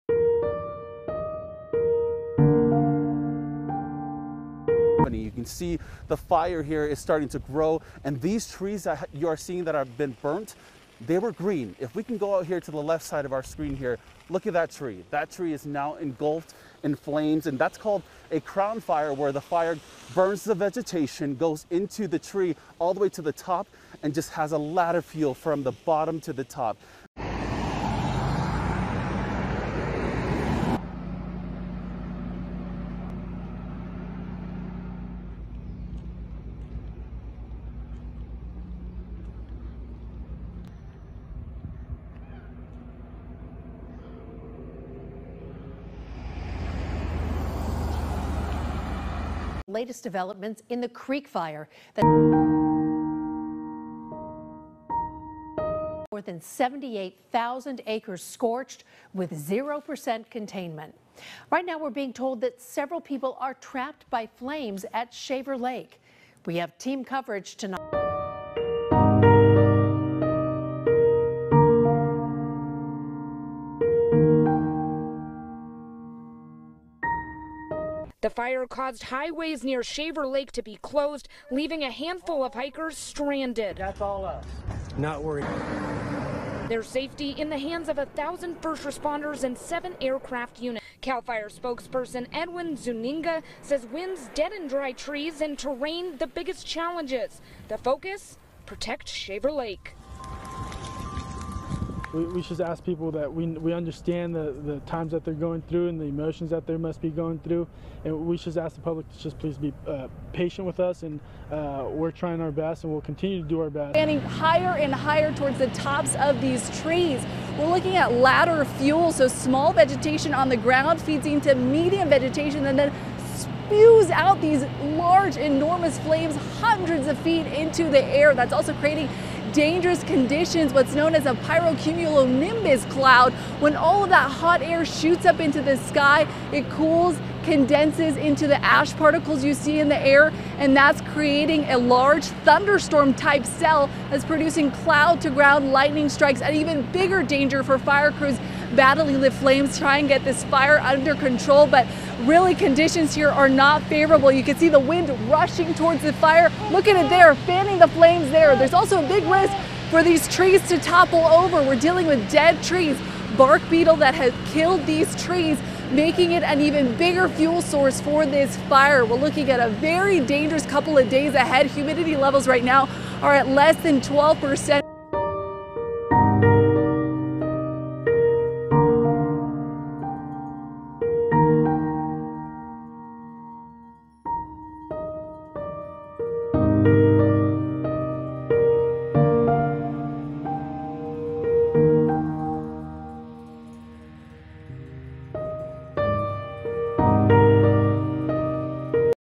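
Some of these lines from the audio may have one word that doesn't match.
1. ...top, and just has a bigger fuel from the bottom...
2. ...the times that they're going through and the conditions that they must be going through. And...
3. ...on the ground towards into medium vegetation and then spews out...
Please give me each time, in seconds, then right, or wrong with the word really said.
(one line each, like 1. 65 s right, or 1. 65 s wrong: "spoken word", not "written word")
1. 23 s wrong: "ladder", not "bigger"
2. 104 s wrong: "emotions", not "conditions"
3. 120 s wrong: "feeds", not "towards".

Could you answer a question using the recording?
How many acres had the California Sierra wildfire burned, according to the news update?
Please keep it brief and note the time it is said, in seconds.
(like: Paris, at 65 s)
78,000, at 56 s.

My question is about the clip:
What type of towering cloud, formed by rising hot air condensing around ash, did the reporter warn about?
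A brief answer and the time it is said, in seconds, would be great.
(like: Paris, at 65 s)
pyrocumulonimbus cloud, at 131 s.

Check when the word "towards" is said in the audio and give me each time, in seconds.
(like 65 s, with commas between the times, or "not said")
115 s, 155 s.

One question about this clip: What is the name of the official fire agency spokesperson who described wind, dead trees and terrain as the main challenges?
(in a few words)
Edwin Zuniga.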